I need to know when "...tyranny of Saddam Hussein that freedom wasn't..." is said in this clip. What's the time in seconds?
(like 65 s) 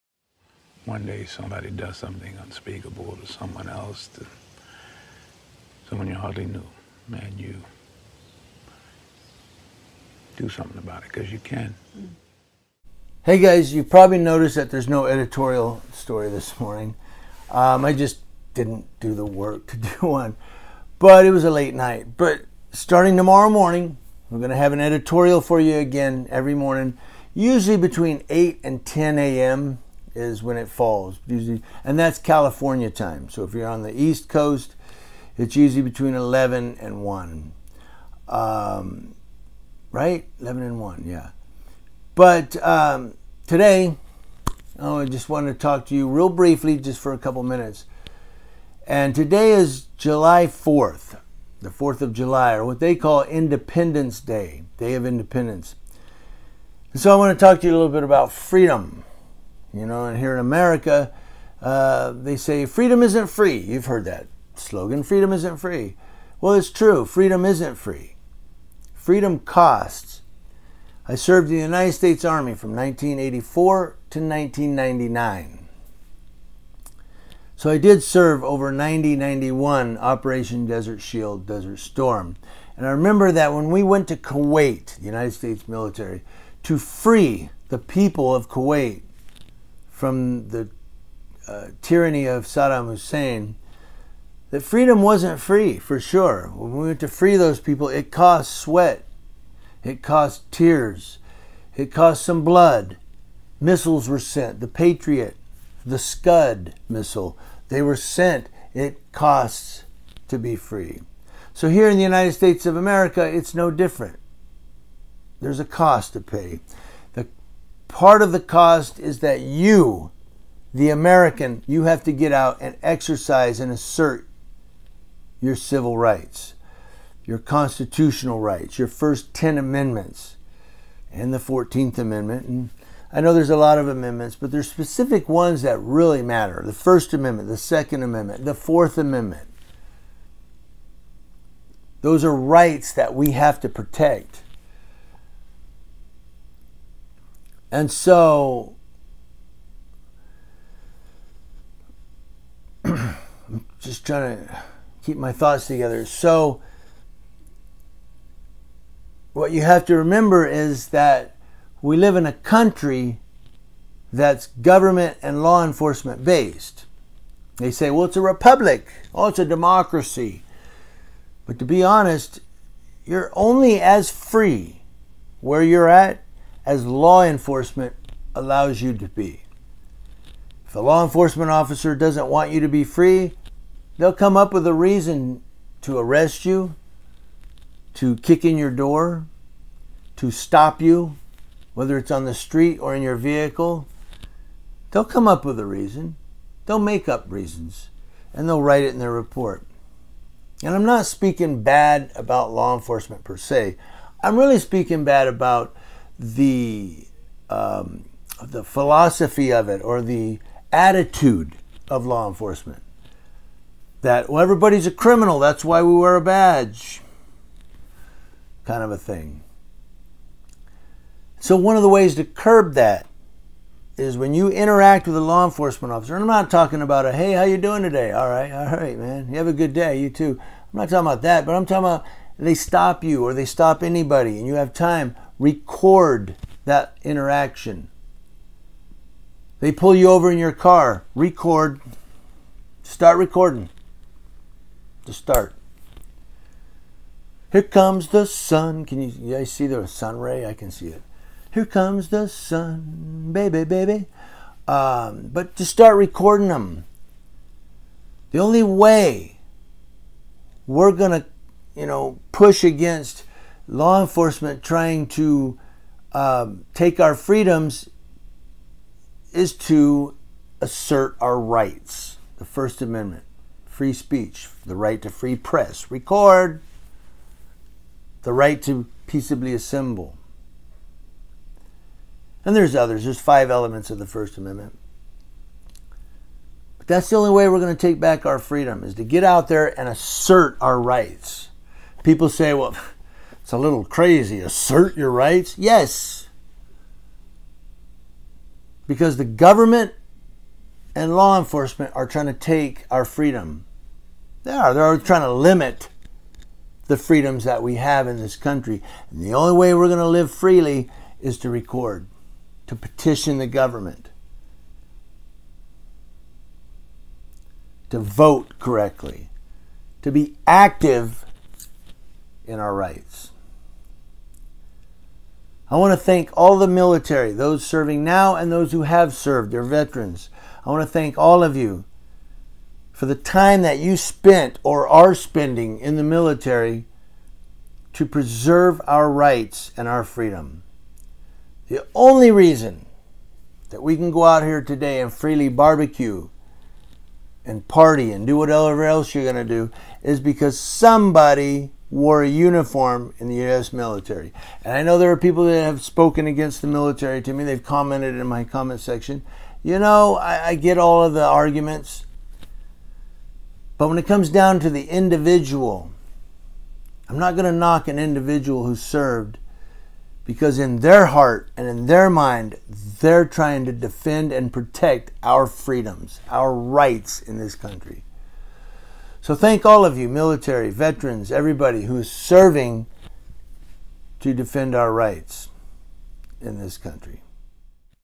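91 s.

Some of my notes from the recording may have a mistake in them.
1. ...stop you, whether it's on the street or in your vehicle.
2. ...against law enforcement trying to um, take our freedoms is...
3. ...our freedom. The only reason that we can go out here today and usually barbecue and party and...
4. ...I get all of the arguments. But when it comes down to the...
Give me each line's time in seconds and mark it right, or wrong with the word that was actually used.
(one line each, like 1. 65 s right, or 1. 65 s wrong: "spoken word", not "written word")
1. 190 s right
2. 262 s right
3. 339 s wrong: "freely", not "usually"
4. 360 s right.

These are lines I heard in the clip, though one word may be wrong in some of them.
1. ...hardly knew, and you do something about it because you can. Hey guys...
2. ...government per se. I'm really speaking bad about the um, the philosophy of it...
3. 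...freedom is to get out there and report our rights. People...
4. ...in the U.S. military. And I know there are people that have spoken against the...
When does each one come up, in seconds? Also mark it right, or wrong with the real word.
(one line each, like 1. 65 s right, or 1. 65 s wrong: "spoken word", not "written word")
1. 6 s right
2. 202 s wrong: "enforcement", not "government"
3. 288 s wrong: "assert", not "report"
4. 353 s right.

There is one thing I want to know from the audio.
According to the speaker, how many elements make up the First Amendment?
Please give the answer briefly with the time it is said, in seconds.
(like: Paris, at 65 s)
5, at 283 s.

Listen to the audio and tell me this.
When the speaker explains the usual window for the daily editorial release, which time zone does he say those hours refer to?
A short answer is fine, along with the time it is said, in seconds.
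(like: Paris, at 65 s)
California time, at 32 s.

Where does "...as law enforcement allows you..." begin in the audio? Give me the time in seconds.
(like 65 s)
176 s.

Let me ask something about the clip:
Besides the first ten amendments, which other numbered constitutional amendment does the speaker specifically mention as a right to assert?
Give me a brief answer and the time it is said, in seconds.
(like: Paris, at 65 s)
14th Amendment, at 131 s.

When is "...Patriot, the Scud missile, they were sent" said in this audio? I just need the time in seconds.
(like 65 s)
104 s.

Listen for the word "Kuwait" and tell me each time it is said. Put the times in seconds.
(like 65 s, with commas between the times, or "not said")
84 s, 88 s.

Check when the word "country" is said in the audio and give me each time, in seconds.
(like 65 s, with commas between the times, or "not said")
162 s, 308 s, 377 s, 386 s.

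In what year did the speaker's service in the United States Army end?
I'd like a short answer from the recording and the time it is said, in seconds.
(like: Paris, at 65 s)
1999, at 74 s.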